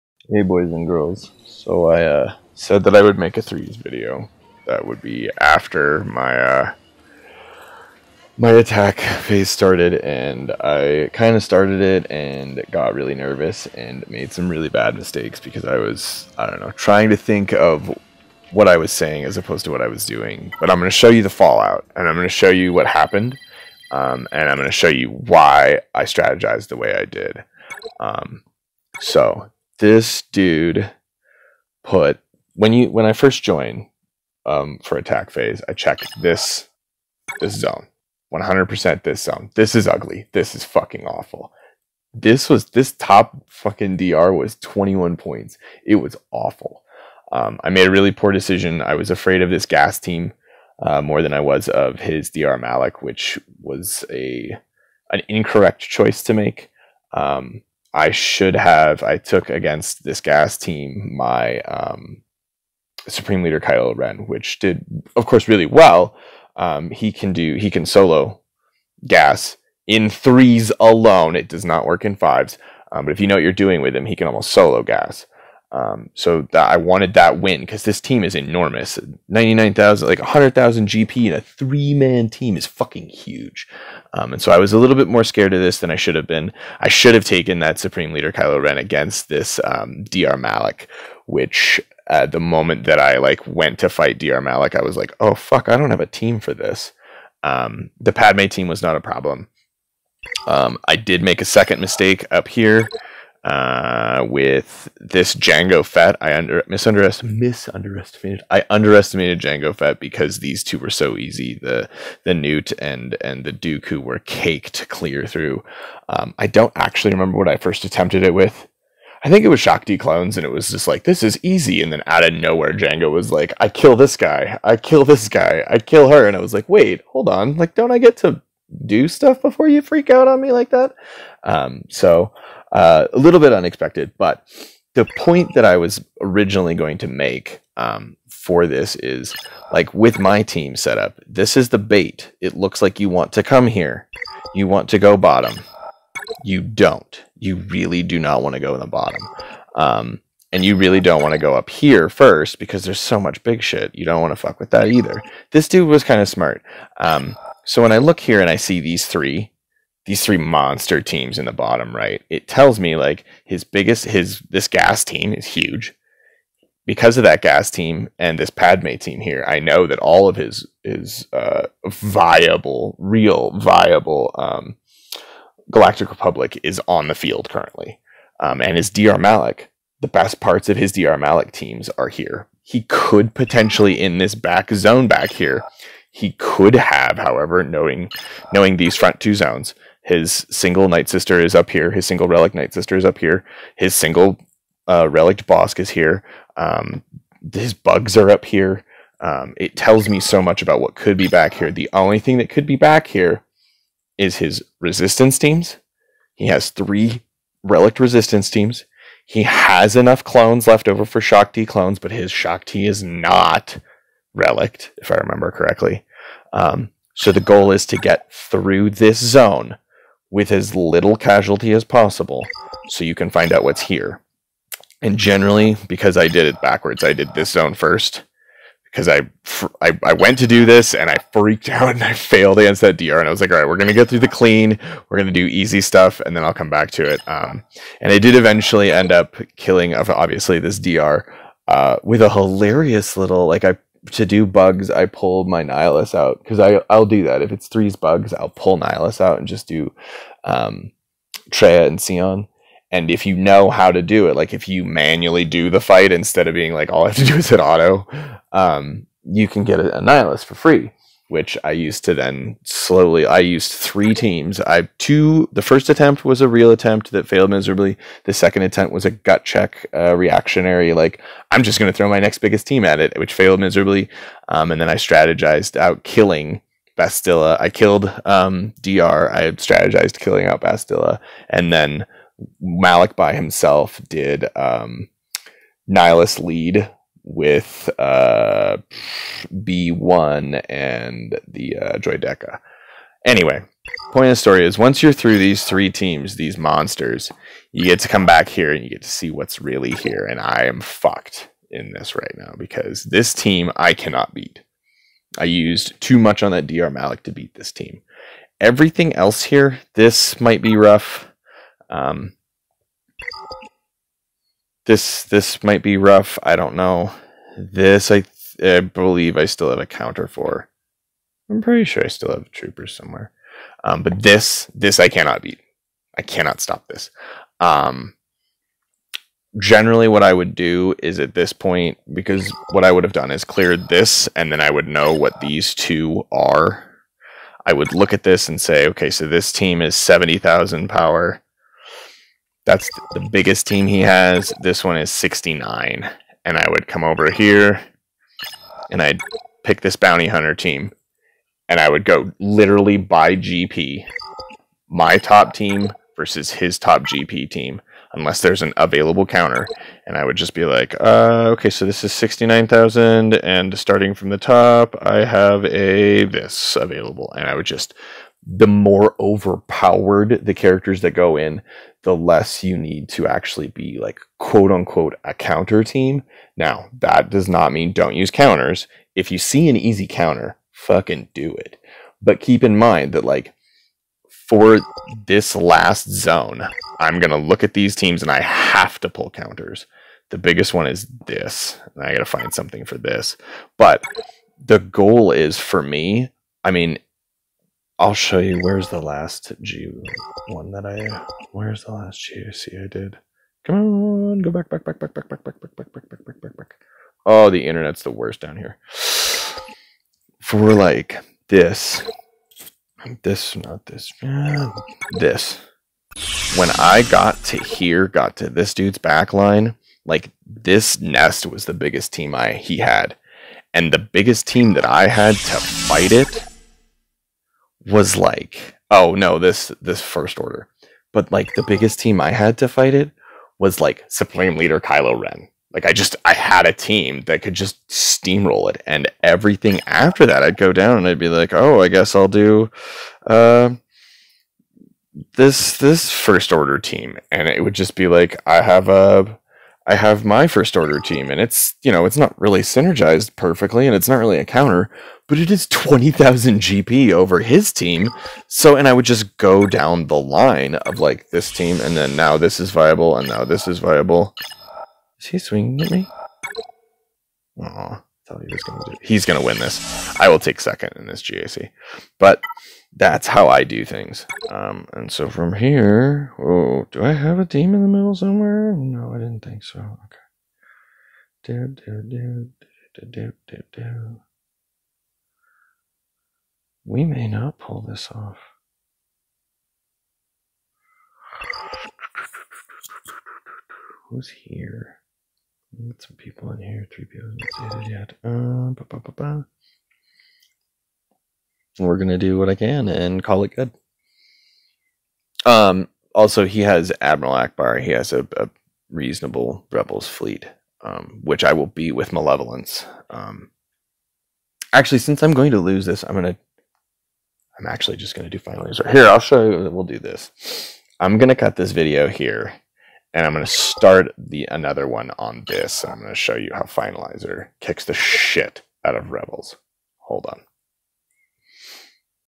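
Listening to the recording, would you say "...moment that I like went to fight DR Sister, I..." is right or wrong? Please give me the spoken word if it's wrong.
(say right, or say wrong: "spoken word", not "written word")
wrong: "Malik", not "Sister".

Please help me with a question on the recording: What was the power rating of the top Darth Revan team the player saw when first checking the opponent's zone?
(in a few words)
21 points.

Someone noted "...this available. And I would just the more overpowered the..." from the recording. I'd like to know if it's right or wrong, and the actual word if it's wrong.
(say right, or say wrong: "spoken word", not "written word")
right.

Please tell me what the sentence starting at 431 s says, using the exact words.
But like the biggest team I had to fight it was like Supreme Leader Kylo Ren.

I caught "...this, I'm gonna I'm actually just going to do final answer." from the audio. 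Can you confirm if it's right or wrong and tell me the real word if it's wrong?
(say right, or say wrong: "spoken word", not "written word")
right.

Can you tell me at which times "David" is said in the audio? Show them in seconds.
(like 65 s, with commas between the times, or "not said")
not said.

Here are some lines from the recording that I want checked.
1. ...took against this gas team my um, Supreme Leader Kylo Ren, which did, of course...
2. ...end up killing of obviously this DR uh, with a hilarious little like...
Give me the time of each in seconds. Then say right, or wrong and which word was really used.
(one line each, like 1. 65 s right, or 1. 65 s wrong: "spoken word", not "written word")
1. 59 s right
2. 238 s right.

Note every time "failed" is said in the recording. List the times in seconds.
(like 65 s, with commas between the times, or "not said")
232 s, 267 s, 273 s.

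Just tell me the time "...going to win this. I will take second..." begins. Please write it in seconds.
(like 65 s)
469 s.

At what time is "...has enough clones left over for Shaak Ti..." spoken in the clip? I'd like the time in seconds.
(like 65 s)
209 s.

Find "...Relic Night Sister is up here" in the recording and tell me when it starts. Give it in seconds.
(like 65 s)
192 s.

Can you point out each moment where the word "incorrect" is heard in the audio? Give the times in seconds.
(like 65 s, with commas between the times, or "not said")
55 s.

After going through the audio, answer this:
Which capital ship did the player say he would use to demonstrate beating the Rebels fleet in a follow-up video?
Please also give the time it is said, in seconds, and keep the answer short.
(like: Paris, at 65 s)
Finalizer, at 526 s.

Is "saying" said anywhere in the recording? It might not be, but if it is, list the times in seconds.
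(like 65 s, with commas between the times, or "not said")
18 s.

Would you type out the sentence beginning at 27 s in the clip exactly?
Um, so this dude put when you when I first join um, for attack phase, I check this this zone.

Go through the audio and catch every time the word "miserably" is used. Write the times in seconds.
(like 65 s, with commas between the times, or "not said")
267 s, 273 s.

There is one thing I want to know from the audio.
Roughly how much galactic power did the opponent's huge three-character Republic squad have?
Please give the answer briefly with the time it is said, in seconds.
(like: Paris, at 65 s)
99,000, at 79 s.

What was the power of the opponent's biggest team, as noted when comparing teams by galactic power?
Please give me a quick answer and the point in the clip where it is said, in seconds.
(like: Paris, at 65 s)
70,000, at 339 s.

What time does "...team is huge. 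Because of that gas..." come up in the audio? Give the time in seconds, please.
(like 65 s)
165 s.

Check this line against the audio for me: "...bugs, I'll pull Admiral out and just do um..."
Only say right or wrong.
wrong.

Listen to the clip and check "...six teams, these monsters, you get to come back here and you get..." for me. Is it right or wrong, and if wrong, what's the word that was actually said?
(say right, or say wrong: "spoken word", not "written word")
wrong: "three", not "six".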